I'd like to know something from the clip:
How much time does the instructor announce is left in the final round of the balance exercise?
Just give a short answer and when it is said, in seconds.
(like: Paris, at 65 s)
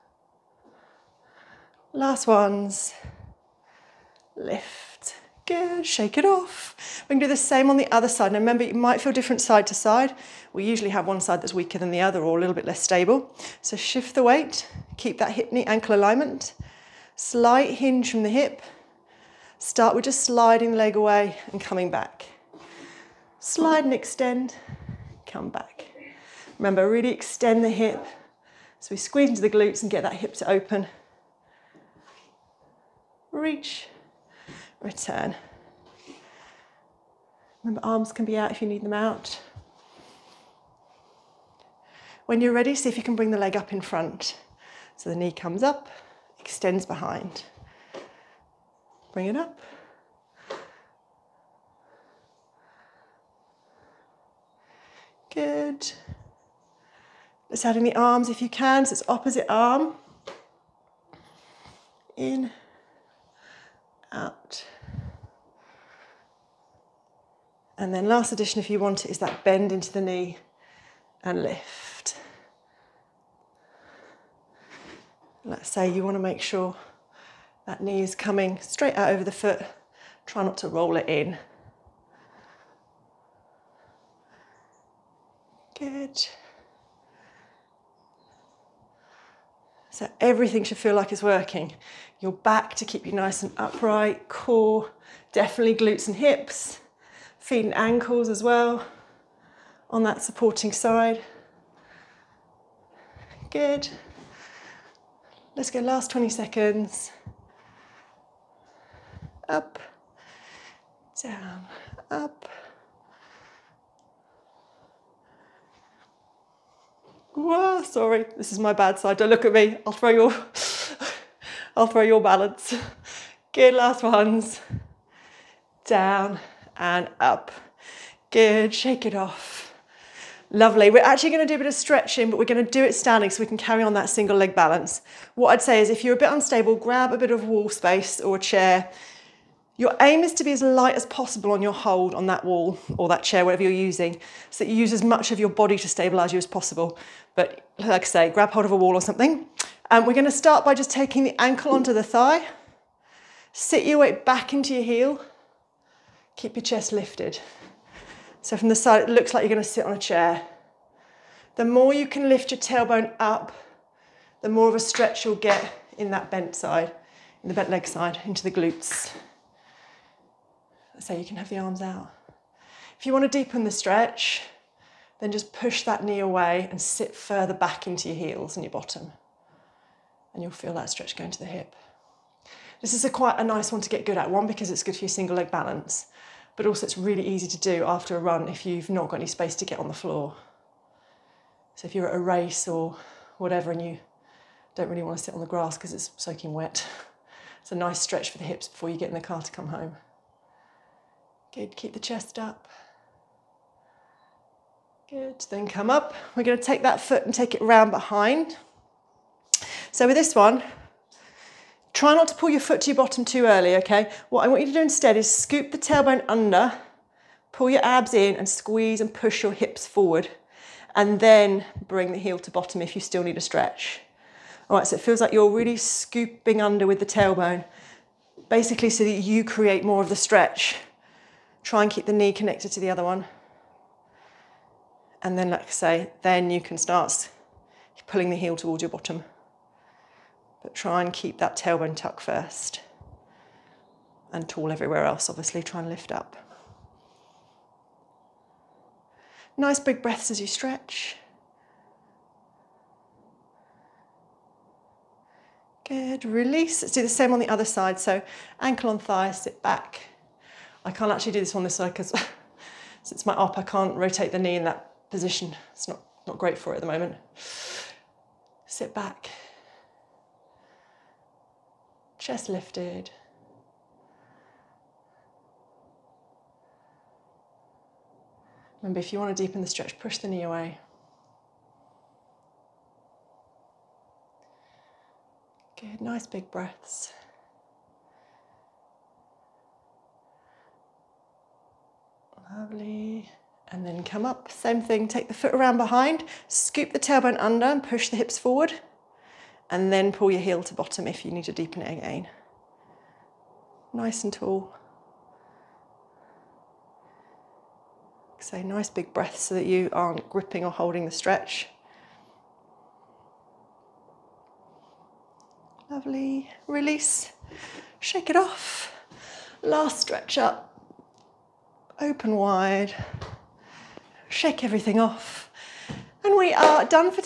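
20 seconds, at 105 s.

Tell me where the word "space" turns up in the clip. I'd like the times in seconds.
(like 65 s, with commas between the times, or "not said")
137 s, 189 s.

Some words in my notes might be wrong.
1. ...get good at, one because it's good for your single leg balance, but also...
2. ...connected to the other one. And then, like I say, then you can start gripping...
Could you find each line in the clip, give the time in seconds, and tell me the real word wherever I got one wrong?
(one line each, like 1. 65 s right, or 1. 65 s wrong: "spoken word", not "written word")
1. 183 s right
2. 232 s wrong: "pulling", not "gripping".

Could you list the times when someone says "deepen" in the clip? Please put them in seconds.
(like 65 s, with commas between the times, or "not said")
173 s, 279 s, 301 s.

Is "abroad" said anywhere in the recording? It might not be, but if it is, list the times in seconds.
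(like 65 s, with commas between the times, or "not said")
not said.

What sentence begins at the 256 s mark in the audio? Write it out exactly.
Let's do the same on the other side.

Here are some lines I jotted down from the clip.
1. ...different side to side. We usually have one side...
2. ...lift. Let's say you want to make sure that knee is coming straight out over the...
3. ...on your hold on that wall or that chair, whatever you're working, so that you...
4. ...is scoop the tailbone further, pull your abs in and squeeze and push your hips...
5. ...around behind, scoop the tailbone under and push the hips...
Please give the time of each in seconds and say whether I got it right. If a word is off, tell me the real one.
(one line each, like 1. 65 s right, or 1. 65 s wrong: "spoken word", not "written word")
1. 9 s right
2. 71 s right
3. 141 s wrong: "using", not "working"
4. 215 s wrong: "under", not "further"
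5. 295 s right.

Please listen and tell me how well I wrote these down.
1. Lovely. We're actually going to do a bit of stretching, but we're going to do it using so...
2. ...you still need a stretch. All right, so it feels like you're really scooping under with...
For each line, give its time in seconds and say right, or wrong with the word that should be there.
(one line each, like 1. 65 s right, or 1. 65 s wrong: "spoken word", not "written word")
1. 130 s wrong: "standing", not "using"
2. 222 s right.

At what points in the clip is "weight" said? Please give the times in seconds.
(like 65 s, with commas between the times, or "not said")
14 s, 153 s.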